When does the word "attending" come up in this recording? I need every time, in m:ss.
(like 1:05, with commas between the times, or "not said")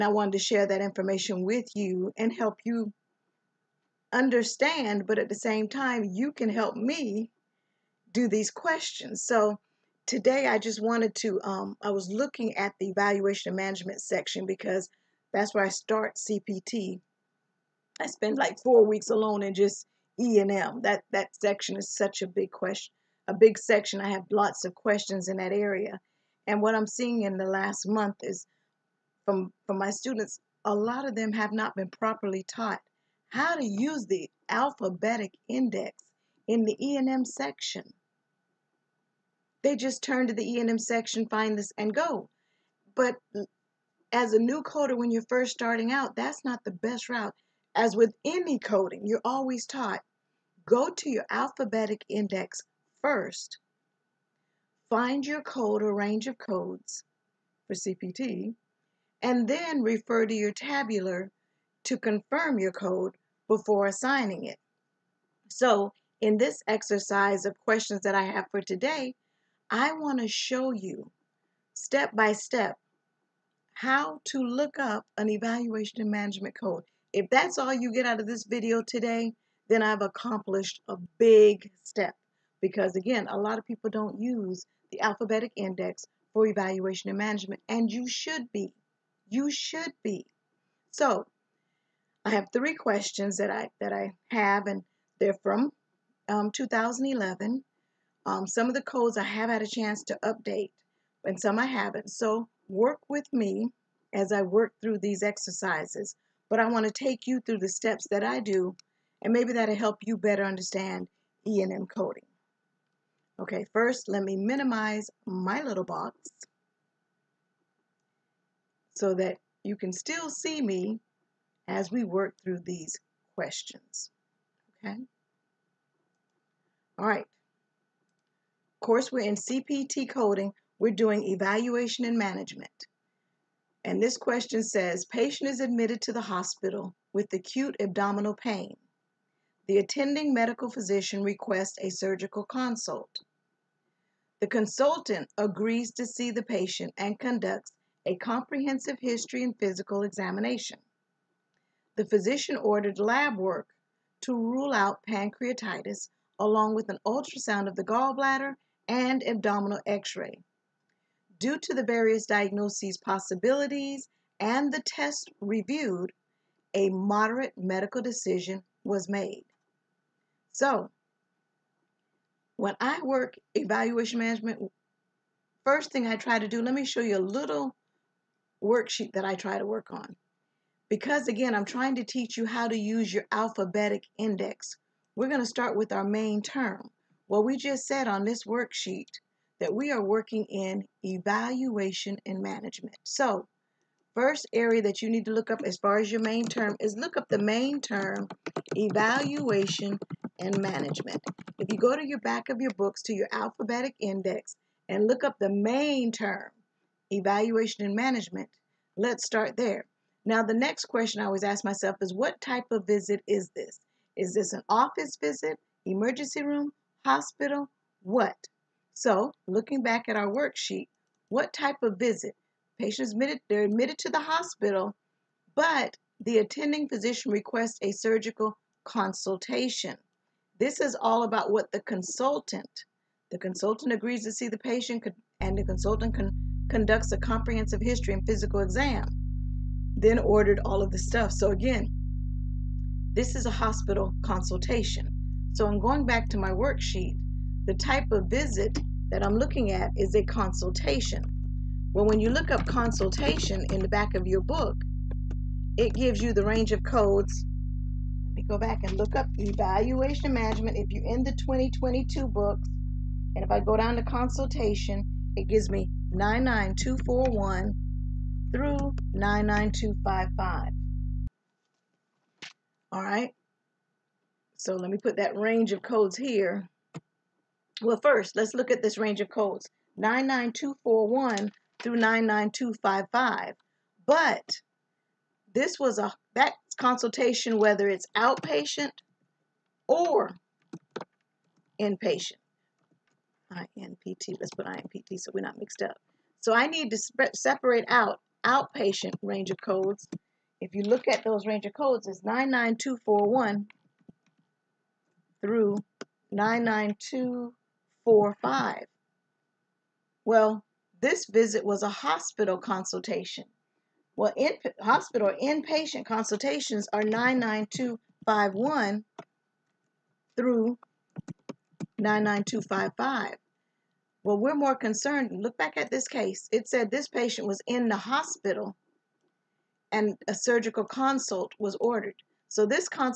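2:19, 3:46.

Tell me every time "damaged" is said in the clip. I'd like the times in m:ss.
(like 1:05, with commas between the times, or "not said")
not said.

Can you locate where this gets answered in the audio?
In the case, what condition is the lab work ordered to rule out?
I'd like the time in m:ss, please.
2:35.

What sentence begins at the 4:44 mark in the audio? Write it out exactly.
But this was a that consultation, whether it's outpatient or inpatient.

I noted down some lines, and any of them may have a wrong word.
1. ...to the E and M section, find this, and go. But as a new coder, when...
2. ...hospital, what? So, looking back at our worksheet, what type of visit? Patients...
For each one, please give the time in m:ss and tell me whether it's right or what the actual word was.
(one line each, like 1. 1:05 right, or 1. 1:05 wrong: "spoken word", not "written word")
1. 0:40 right
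2. 3:37 right.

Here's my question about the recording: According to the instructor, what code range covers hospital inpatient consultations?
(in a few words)
99251 through 99255.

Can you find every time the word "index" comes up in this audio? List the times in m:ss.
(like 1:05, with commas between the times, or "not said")
0:35, 0:52, 1:25, 3:04, 3:23.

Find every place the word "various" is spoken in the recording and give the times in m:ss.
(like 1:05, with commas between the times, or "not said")
2:41.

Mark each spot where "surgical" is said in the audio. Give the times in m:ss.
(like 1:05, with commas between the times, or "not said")
2:21, 3:47, 5:30.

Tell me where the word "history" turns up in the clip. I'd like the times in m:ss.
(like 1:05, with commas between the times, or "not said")
2:29, 3:57.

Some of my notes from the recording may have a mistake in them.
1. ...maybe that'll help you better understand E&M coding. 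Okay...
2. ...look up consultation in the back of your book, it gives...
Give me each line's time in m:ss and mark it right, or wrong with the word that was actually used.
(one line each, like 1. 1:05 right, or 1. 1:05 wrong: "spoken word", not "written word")
1. 1:49 right
2. 4:12 right.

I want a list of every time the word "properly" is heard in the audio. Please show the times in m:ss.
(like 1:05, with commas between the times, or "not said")
0:31.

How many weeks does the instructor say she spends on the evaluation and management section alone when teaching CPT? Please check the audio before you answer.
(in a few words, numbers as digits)
4.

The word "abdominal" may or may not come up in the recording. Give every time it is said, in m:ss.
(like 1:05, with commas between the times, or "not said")
2:17, 2:39.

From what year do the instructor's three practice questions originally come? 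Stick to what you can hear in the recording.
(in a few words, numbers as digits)
2011.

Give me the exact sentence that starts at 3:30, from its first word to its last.
Now, the next question I always ask myself is what type of visit is this?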